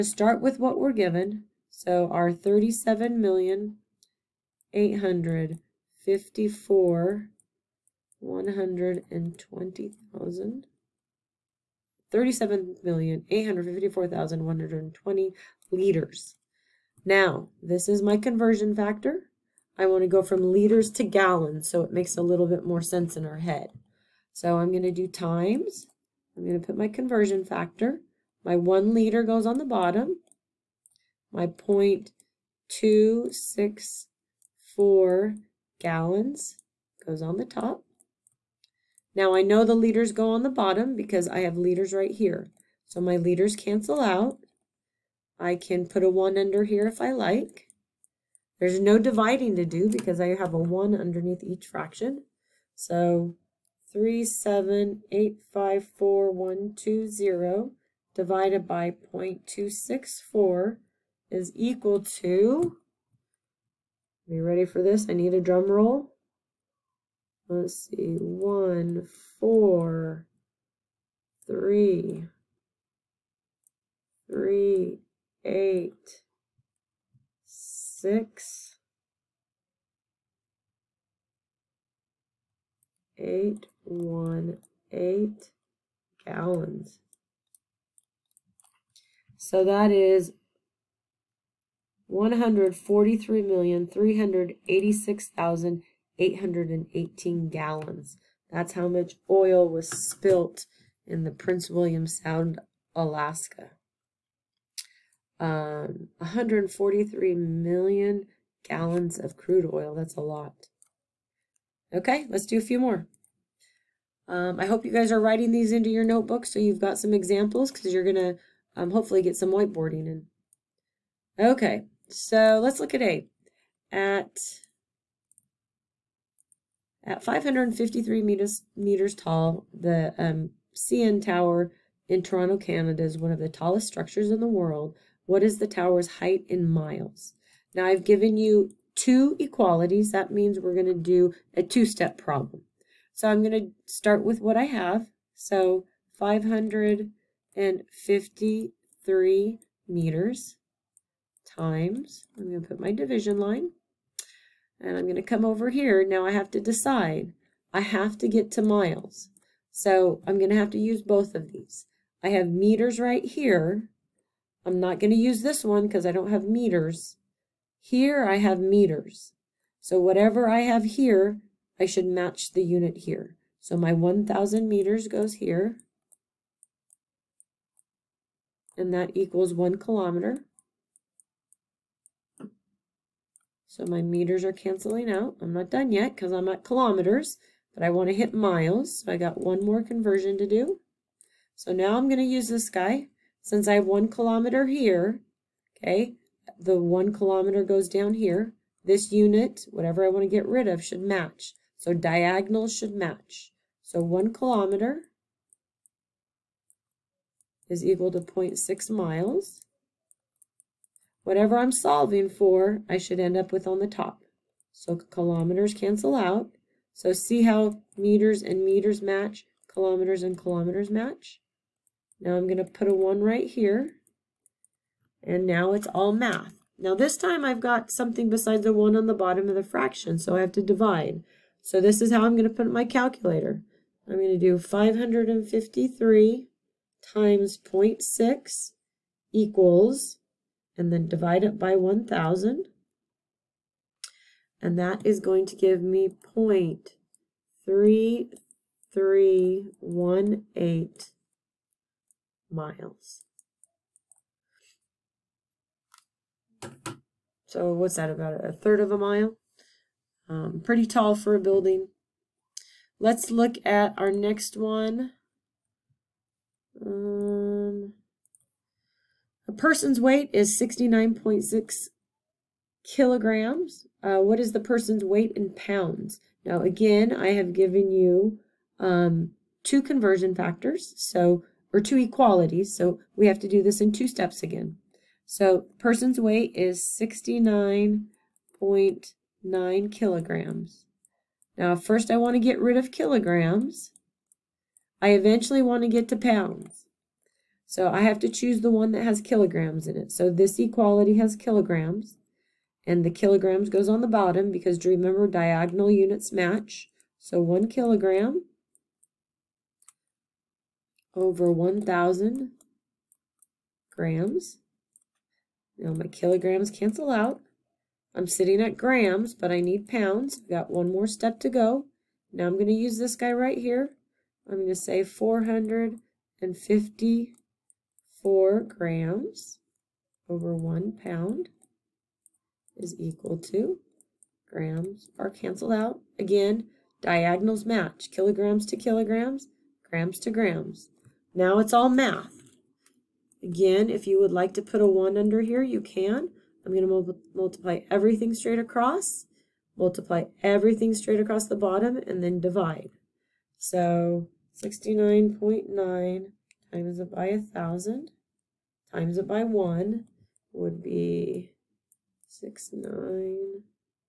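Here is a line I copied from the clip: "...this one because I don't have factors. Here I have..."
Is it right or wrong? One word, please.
wrong.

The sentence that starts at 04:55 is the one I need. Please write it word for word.
I eventually want to get to pounds.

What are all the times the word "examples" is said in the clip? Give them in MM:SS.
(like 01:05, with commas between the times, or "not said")
01:57.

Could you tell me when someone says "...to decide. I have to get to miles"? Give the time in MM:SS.
02:36.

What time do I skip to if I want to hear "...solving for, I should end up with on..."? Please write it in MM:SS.
03:31.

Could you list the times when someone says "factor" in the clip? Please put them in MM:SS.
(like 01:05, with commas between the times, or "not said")
00:27, 04:40.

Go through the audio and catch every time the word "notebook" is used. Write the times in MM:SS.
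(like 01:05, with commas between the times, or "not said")
01:56.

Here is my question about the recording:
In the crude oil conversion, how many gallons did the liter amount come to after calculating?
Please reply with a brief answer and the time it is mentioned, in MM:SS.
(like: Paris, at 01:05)
143 million gallons, at 01:46.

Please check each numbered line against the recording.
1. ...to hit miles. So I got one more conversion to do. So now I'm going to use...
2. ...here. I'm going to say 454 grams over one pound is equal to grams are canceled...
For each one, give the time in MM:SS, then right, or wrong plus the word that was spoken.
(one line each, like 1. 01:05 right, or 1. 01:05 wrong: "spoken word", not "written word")
1. 03:08 right
2. 05:23 right.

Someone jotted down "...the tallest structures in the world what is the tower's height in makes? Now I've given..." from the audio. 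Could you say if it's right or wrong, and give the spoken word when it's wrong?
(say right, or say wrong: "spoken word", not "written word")
wrong: "miles", not "makes".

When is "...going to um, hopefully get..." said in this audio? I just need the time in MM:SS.
01:58.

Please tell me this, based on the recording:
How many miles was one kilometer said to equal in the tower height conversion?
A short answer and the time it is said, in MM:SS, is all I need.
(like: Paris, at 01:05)
0.6 miles, at 03:28.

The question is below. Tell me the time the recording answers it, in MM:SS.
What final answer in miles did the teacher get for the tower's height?
04:06.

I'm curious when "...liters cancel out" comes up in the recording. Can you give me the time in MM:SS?
00:43.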